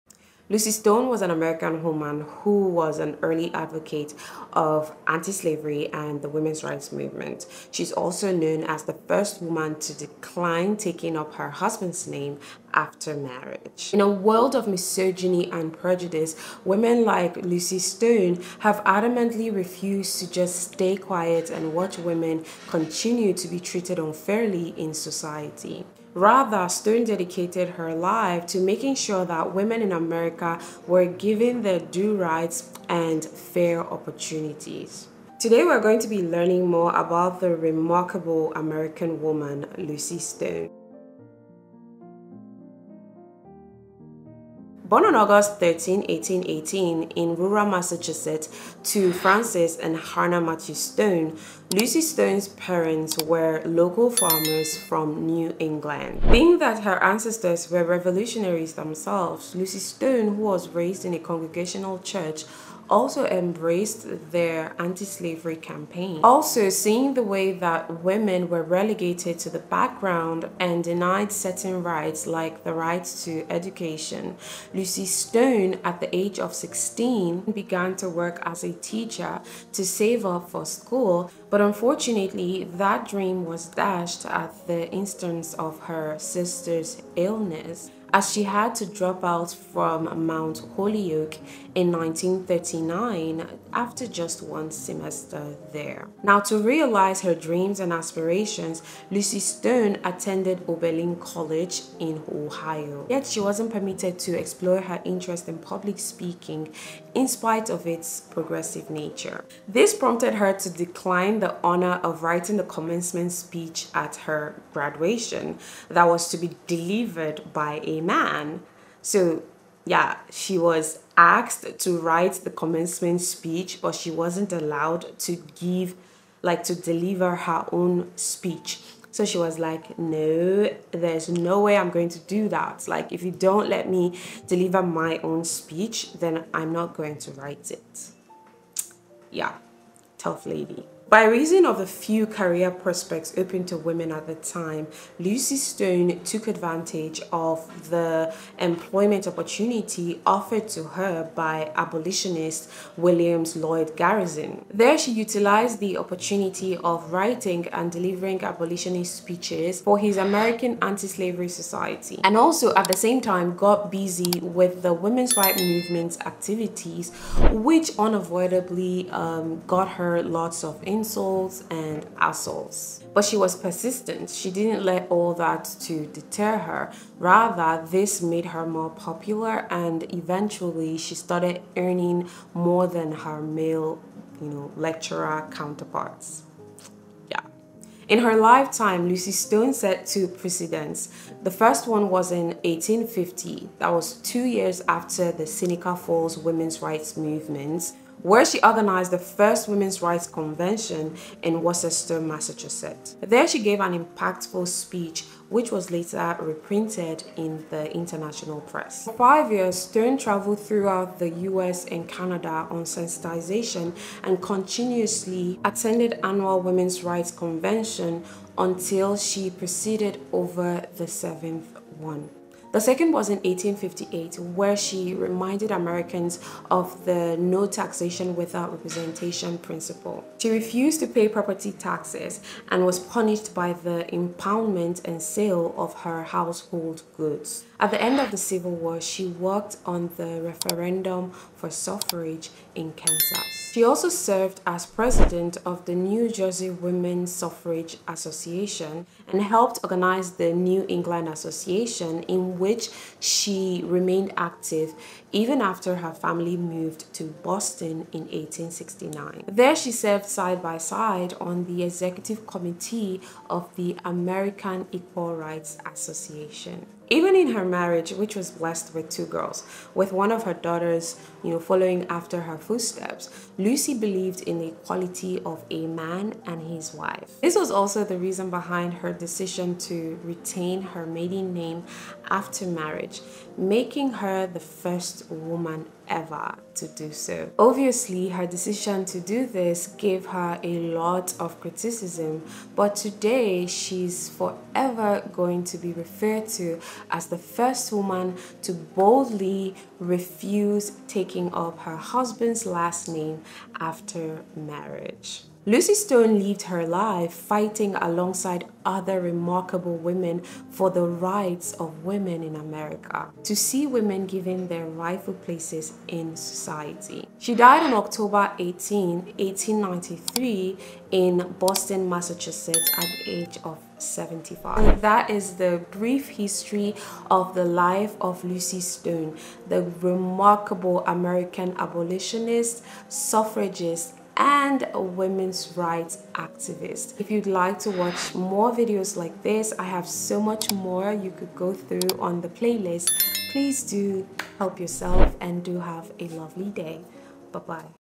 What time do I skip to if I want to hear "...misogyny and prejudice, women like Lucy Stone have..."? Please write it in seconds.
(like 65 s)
14 s.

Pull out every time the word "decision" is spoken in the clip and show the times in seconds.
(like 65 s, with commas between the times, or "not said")
279 s, 288 s.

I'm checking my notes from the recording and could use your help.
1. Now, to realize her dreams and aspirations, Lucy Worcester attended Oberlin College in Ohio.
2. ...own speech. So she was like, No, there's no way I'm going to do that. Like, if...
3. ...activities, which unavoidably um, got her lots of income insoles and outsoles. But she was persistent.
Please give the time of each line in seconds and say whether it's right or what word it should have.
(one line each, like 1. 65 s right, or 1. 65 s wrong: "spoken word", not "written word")
1. 96 s wrong: "Stone", not "Worcester"
2. 127 s right
3. 166 s right.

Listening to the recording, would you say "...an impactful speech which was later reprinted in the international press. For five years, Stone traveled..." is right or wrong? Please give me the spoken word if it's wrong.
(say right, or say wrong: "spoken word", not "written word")
right.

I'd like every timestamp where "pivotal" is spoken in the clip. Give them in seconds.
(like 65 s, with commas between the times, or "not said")
not said.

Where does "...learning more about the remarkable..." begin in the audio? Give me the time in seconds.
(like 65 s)
36 s.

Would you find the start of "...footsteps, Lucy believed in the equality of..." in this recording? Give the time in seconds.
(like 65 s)
272 s.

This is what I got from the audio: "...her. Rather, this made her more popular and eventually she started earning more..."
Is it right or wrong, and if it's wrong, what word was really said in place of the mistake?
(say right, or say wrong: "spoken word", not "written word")
right.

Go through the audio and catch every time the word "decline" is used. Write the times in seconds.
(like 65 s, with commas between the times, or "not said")
9 s, 110 s.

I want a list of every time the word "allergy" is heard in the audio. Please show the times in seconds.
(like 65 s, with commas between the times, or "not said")
not said.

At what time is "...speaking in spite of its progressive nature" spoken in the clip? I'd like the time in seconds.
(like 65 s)
105 s.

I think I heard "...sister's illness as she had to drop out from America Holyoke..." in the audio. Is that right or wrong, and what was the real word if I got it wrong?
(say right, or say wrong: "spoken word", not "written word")
wrong: "Mount", not "America".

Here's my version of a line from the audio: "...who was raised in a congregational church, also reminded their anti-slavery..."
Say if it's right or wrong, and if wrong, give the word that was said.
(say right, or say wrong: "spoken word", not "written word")
wrong: "embraced", not "reminded".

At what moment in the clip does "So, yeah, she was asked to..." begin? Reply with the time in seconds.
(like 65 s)
119 s.